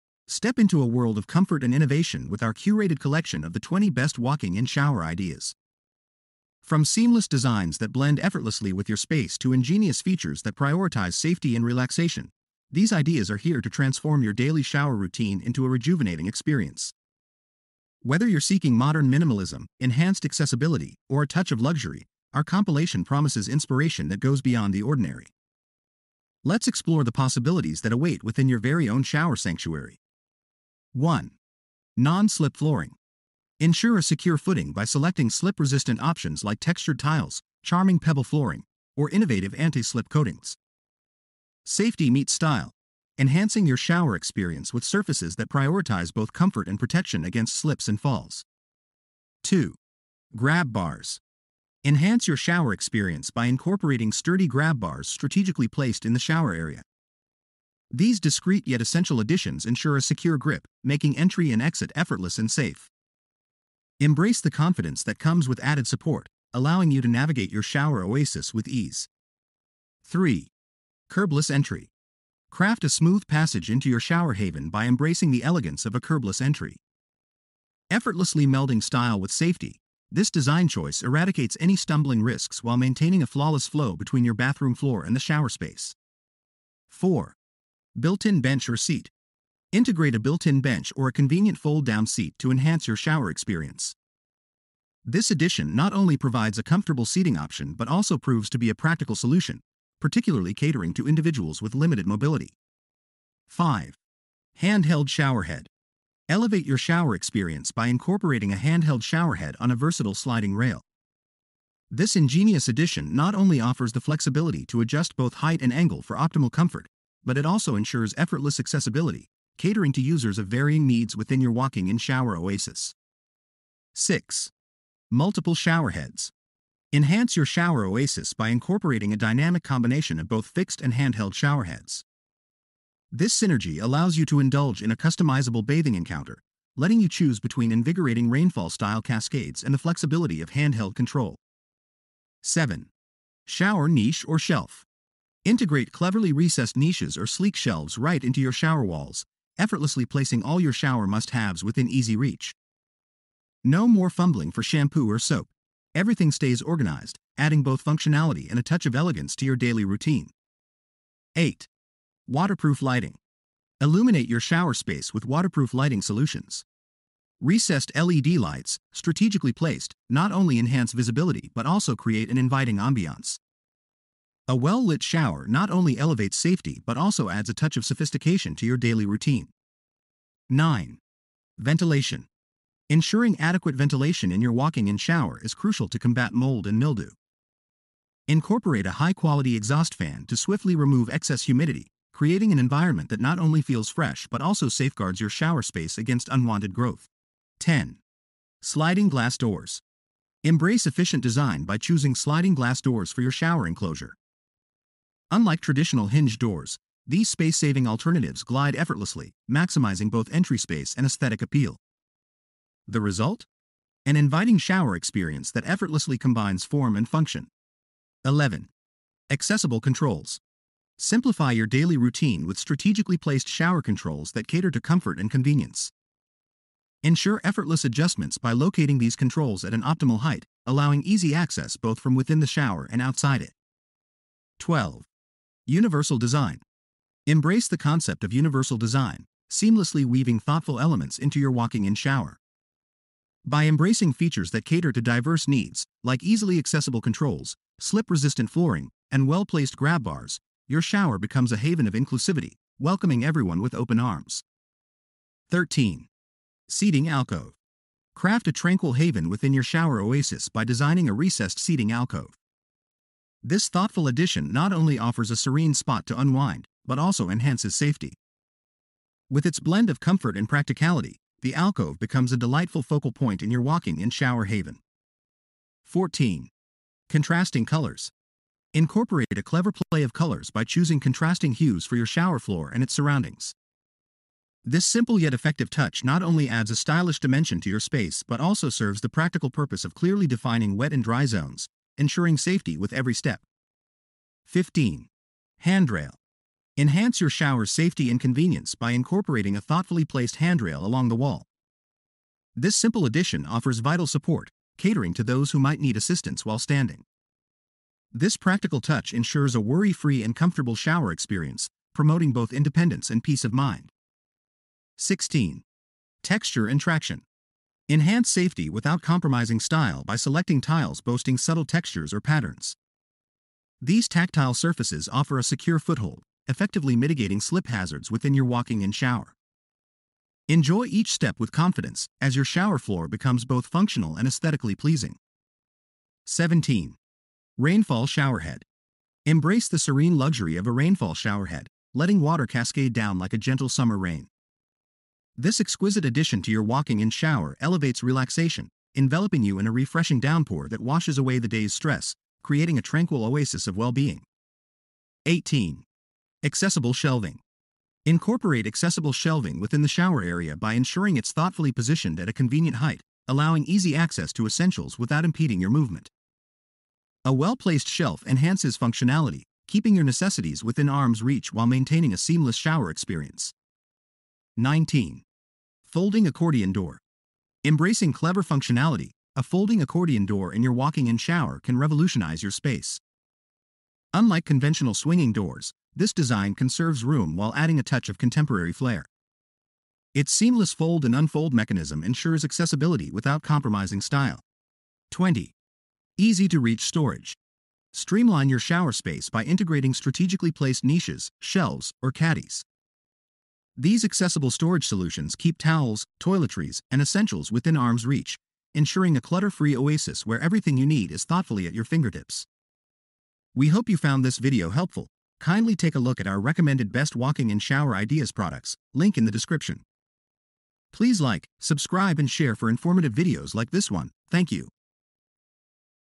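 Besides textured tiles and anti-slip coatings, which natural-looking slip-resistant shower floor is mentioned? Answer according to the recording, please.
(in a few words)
pebble flooring.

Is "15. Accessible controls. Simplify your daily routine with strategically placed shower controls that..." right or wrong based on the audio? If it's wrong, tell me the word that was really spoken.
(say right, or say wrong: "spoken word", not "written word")
wrong: "11", not "15".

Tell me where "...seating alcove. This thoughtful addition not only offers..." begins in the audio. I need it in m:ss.
4:21.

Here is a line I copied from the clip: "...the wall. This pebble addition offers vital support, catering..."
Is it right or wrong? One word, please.
wrong.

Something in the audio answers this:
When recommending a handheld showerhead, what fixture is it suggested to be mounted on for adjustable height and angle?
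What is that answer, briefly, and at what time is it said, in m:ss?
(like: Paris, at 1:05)
sliding rail, at 1:50.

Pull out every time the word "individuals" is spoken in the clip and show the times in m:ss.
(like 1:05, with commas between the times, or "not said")
1:41.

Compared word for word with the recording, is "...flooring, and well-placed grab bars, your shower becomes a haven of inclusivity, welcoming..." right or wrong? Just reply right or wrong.
right.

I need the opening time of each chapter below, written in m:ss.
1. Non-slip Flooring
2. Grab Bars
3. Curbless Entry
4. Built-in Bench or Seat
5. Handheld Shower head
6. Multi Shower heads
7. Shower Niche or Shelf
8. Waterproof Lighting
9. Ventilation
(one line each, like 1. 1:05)
1. 0:30
2. 0:49
3. 1:10
4. 1:27
5. 1:43
6. 2:04
7. 2:22
8. 2:41
9. 3:00.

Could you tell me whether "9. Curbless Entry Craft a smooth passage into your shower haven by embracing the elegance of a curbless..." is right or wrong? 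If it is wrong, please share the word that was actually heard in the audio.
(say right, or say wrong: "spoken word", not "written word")
wrong: "3", not "9".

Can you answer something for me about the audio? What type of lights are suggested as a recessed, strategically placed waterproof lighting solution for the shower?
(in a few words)
LED lights.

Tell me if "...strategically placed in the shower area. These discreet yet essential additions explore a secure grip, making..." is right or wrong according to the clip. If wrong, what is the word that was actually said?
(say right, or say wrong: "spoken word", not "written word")
wrong: "ensure", not "explore".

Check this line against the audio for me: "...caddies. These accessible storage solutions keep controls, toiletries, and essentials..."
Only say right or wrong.
wrong.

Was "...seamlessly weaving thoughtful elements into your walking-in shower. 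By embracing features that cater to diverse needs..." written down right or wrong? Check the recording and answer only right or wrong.
right.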